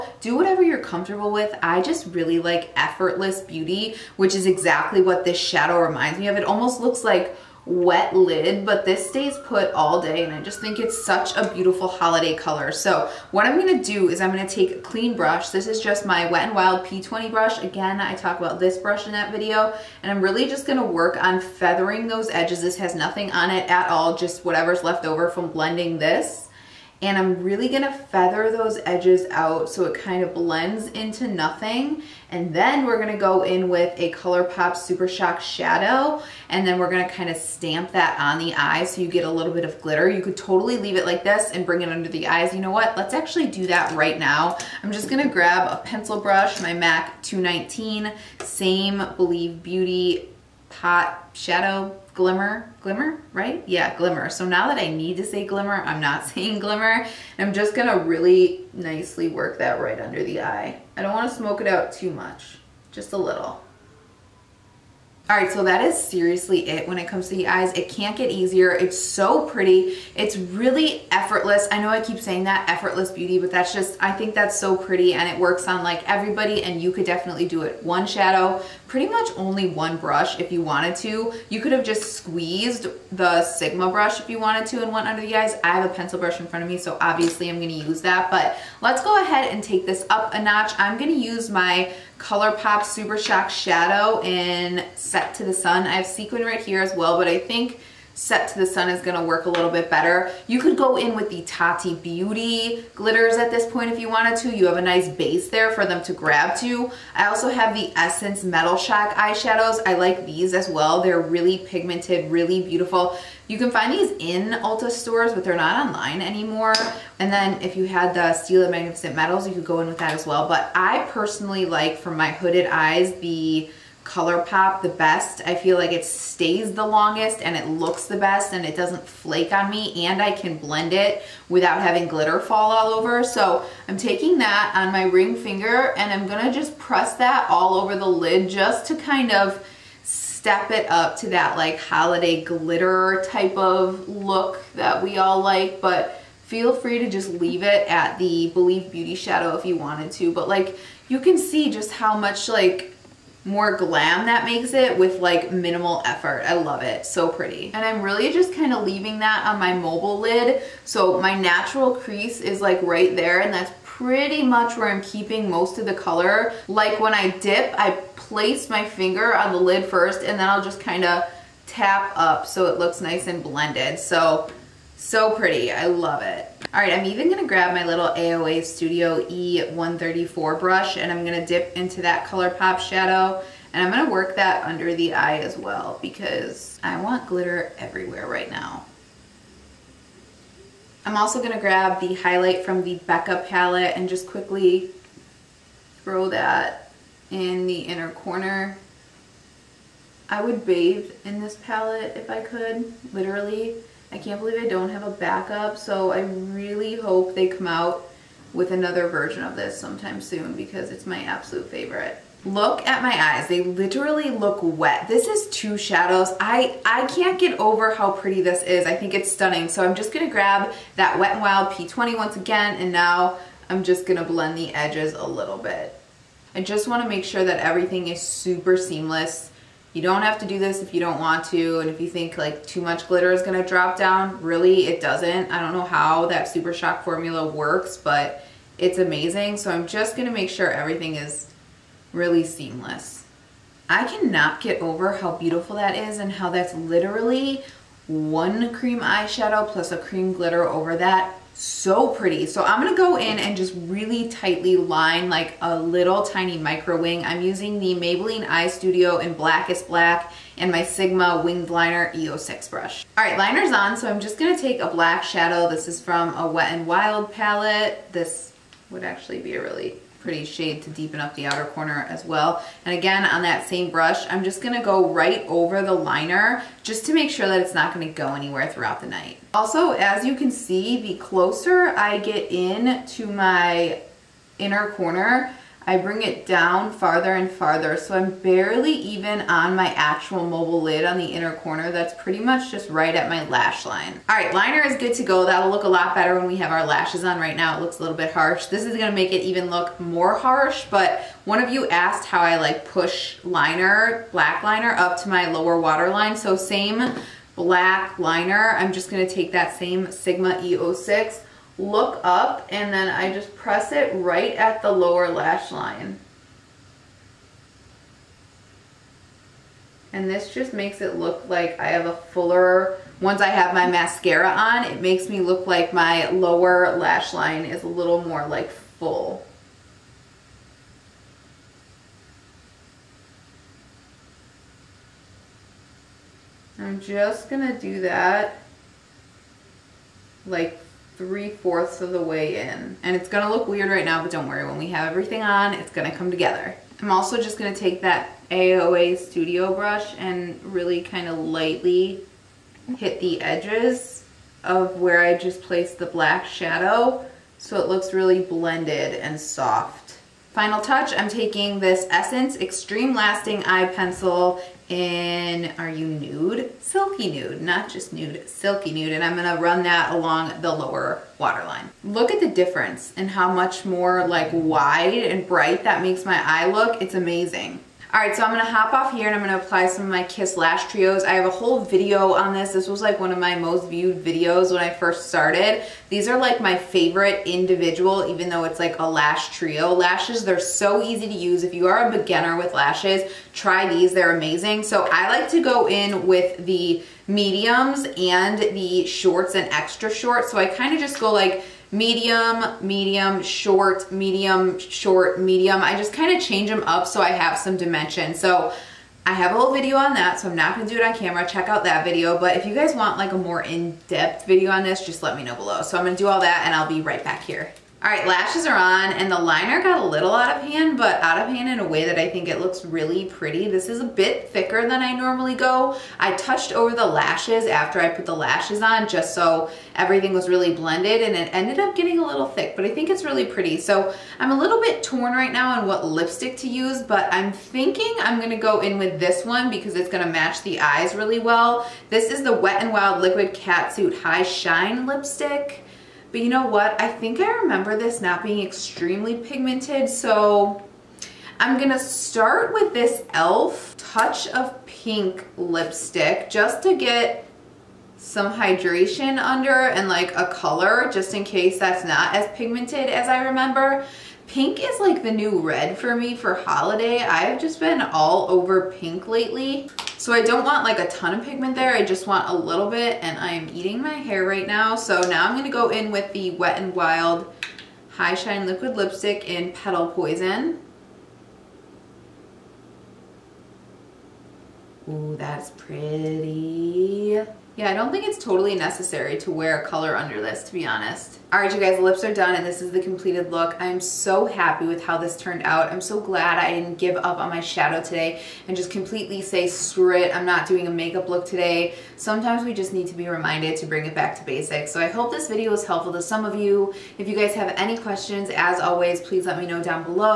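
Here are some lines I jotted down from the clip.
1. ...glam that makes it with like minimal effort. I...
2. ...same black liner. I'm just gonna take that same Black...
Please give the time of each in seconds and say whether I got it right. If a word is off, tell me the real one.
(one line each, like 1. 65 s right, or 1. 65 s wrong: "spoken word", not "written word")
1. 153 s right
2. 306 s wrong: "Sigma", not "Black".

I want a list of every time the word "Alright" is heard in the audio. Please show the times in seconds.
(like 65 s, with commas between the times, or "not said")
378 s.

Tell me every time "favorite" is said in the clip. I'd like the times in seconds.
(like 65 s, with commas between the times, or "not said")
211 s, 386 s.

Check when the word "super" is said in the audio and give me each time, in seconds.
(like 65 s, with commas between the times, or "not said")
34 s, 92 s, 228 s, 236 s.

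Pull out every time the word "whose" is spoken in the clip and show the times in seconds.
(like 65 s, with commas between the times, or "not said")
not said.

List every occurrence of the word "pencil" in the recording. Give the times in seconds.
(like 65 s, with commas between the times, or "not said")
45 s, 85 s, 363 s.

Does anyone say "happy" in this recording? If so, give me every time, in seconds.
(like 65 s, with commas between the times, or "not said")
494 s.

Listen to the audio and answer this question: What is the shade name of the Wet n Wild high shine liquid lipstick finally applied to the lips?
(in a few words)
Petal Poison.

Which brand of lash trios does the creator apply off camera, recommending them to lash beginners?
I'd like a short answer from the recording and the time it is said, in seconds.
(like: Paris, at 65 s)
Kiss, at 380 s.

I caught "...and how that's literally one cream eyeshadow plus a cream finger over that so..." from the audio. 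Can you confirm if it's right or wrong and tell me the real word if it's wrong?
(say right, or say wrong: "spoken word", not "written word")
wrong: "glitter", not "finger".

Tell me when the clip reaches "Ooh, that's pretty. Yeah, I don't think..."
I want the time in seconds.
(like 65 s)
485 s.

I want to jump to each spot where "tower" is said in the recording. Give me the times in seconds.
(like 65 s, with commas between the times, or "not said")
not said.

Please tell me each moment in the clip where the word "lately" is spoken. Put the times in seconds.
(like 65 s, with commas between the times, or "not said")
469 s.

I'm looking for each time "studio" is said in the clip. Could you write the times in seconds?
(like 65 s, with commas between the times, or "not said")
178 s, 258 s, 349 s.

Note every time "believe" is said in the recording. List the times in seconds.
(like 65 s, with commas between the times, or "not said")
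49 s, 148 s, 204 s.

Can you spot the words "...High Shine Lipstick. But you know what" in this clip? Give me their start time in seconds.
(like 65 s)
444 s.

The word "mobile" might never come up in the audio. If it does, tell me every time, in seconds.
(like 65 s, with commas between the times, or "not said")
159 s, 290 s.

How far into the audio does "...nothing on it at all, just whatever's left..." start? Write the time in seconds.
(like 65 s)
22 s.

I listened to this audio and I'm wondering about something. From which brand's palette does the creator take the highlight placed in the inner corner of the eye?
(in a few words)
Becca.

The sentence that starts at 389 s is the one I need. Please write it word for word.
Lashes, they're so easy to use.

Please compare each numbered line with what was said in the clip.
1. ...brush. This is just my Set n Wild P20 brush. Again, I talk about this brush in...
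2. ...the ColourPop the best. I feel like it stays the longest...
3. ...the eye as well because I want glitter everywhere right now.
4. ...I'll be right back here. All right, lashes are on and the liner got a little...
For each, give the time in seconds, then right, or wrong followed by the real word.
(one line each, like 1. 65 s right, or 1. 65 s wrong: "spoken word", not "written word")
1. 15 s wrong: "Wet", not "Set"
2. 123 s right
3. 184 s right
4. 416 s right.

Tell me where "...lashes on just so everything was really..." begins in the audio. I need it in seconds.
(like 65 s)
428 s.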